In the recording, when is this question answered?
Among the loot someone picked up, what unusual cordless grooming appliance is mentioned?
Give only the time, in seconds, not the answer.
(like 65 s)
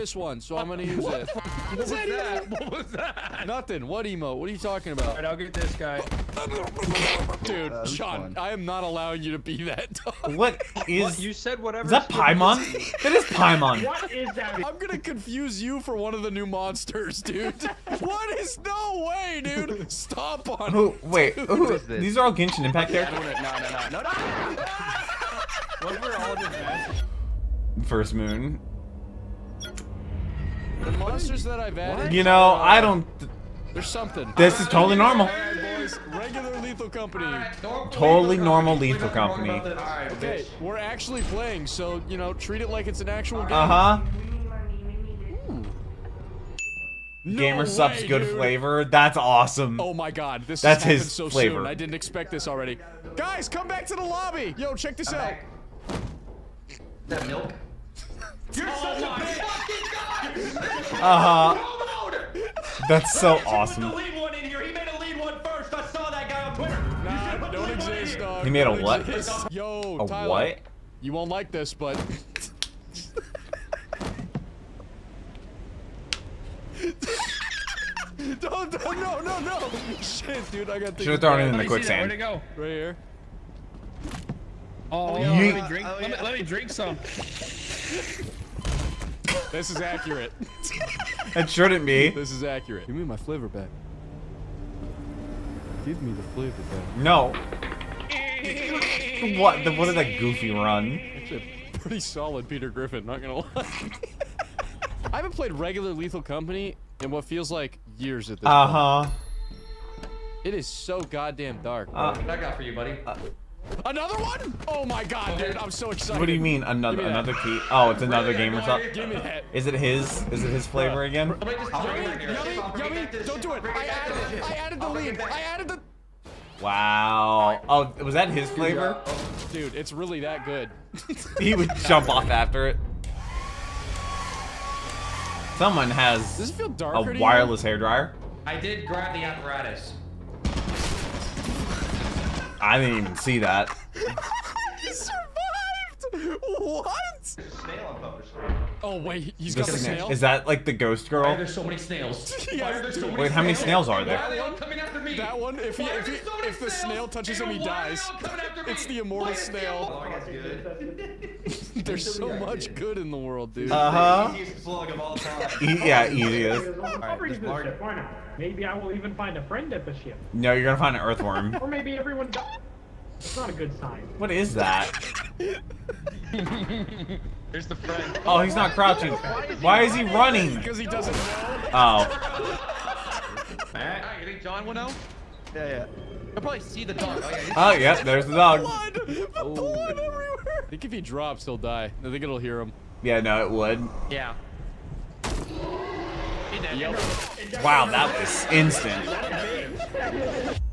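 137 s.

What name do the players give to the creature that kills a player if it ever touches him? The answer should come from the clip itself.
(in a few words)
the immortal snail.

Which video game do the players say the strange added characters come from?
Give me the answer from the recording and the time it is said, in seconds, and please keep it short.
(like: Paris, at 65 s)
Genshin Impact, at 22 s.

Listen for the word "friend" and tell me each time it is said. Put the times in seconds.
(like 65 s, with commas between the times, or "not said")
169 s, 177 s.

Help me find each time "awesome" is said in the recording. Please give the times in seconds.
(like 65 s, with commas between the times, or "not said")
49 s, 63 s.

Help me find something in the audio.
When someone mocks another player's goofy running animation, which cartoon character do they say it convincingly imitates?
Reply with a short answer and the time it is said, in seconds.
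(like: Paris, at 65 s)
Peter Griffin, at 102 s.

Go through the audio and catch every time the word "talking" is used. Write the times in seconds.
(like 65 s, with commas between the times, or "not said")
4 s.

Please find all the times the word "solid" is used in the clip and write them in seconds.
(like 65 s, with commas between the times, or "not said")
101 s.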